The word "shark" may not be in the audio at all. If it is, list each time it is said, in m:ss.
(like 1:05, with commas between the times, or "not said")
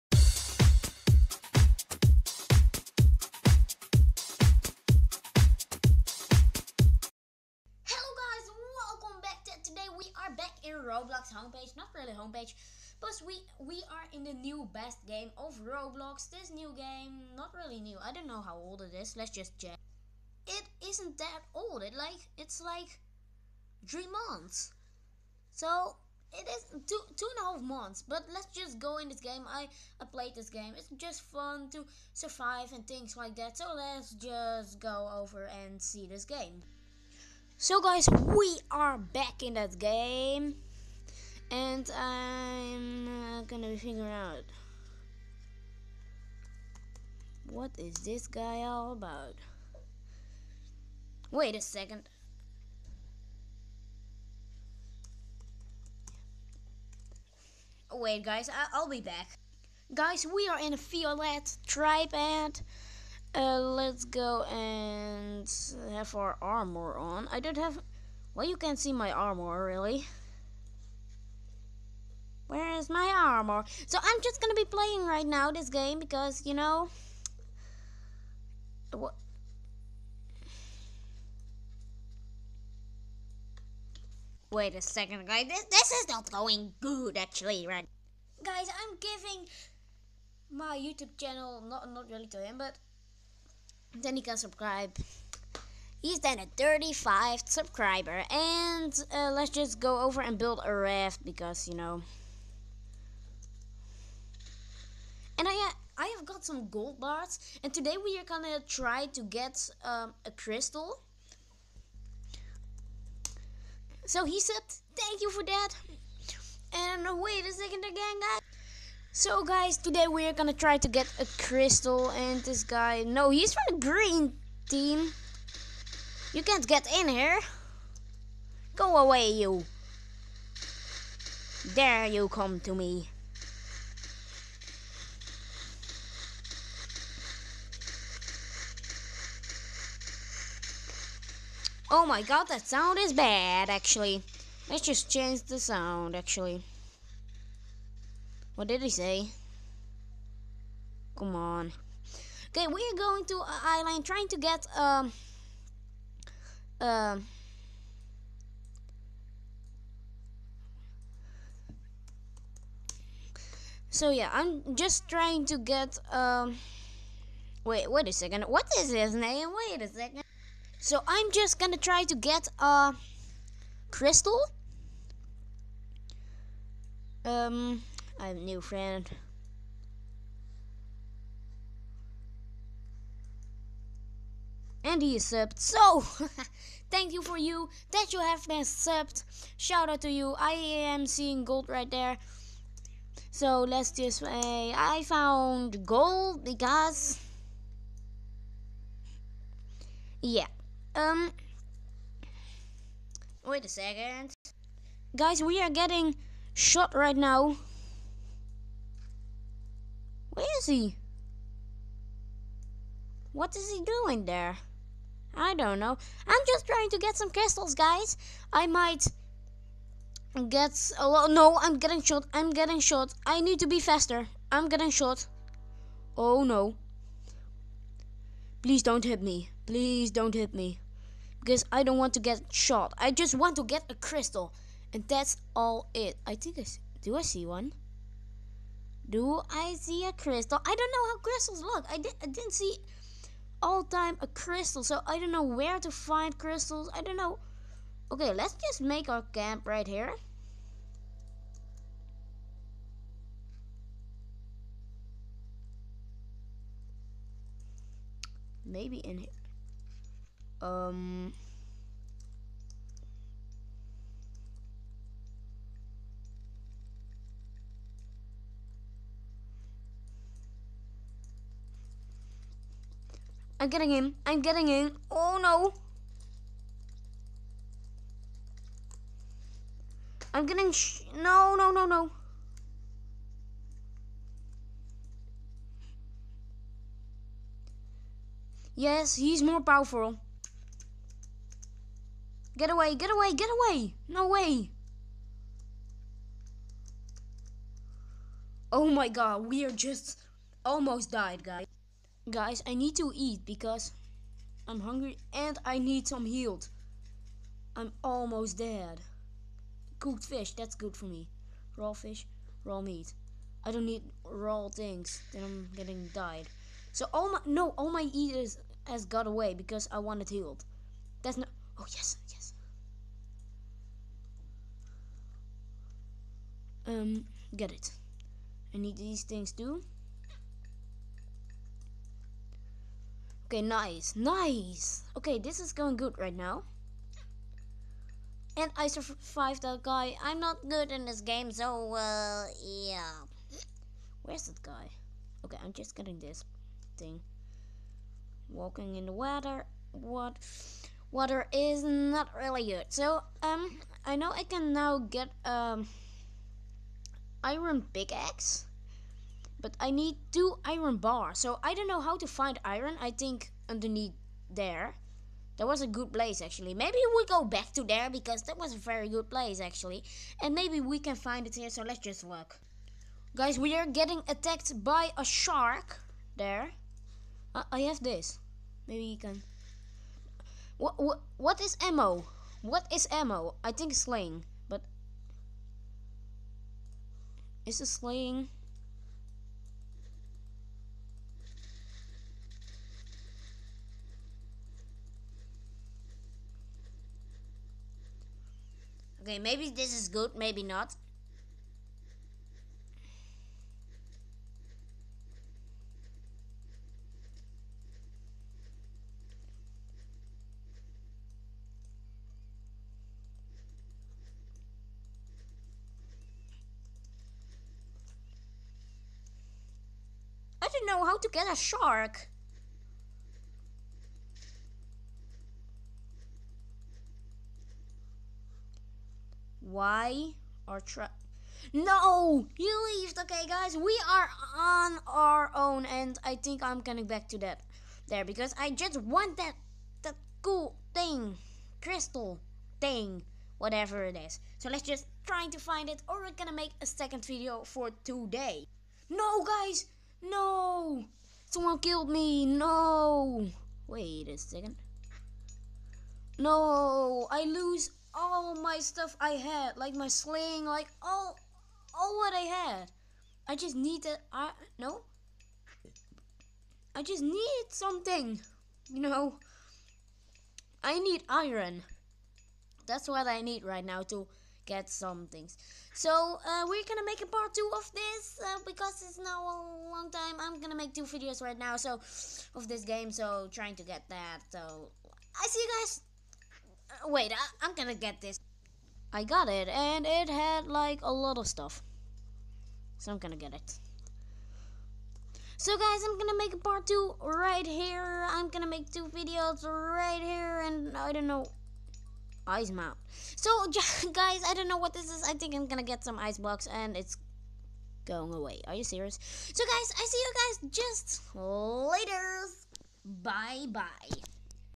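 6:15, 7:01.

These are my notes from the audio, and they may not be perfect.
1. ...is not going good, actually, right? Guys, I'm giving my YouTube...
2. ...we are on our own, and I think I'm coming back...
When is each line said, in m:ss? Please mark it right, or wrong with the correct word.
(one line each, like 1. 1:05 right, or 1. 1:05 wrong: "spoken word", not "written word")
1. 1:25 right
2. 7:13 right.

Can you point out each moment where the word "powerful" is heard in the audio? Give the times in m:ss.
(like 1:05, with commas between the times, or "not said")
4:49.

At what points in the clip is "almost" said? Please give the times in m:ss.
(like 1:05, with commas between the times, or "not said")
5:00, 5:08.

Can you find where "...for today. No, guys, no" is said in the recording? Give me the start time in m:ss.
7:27.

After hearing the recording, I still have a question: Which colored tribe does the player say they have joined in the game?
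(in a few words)
Violet.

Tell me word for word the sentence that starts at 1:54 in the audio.
So he said, thank you for that.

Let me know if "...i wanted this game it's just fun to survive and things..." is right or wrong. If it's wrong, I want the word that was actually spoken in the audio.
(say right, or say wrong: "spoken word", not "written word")
wrong: "played", not "wanted".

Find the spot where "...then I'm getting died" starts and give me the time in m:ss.
5:15.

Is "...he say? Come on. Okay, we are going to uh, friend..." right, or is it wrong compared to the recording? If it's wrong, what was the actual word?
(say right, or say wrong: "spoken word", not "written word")
wrong: "island", not "friend".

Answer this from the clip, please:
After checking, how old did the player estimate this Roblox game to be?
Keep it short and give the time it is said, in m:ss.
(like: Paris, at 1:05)
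2 and a half months, at 0:26.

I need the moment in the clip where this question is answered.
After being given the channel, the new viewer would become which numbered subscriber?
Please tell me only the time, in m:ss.
1:36.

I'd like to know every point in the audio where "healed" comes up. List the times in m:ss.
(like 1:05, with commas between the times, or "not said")
5:06, 5:20.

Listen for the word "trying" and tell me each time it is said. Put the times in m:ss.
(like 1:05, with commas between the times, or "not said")
2:34, 2:45, 3:36, 8:03.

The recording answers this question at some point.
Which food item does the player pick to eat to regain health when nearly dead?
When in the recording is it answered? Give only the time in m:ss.
5:09.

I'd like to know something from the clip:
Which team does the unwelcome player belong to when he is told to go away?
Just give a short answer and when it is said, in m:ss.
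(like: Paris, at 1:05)
green team, at 2:03.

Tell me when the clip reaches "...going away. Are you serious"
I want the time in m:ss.
8:28.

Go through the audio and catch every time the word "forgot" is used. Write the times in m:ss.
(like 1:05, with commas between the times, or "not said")
not said.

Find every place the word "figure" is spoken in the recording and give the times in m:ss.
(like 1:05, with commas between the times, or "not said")
0:43.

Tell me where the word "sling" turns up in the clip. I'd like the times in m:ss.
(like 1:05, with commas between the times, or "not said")
6:23, 7:40.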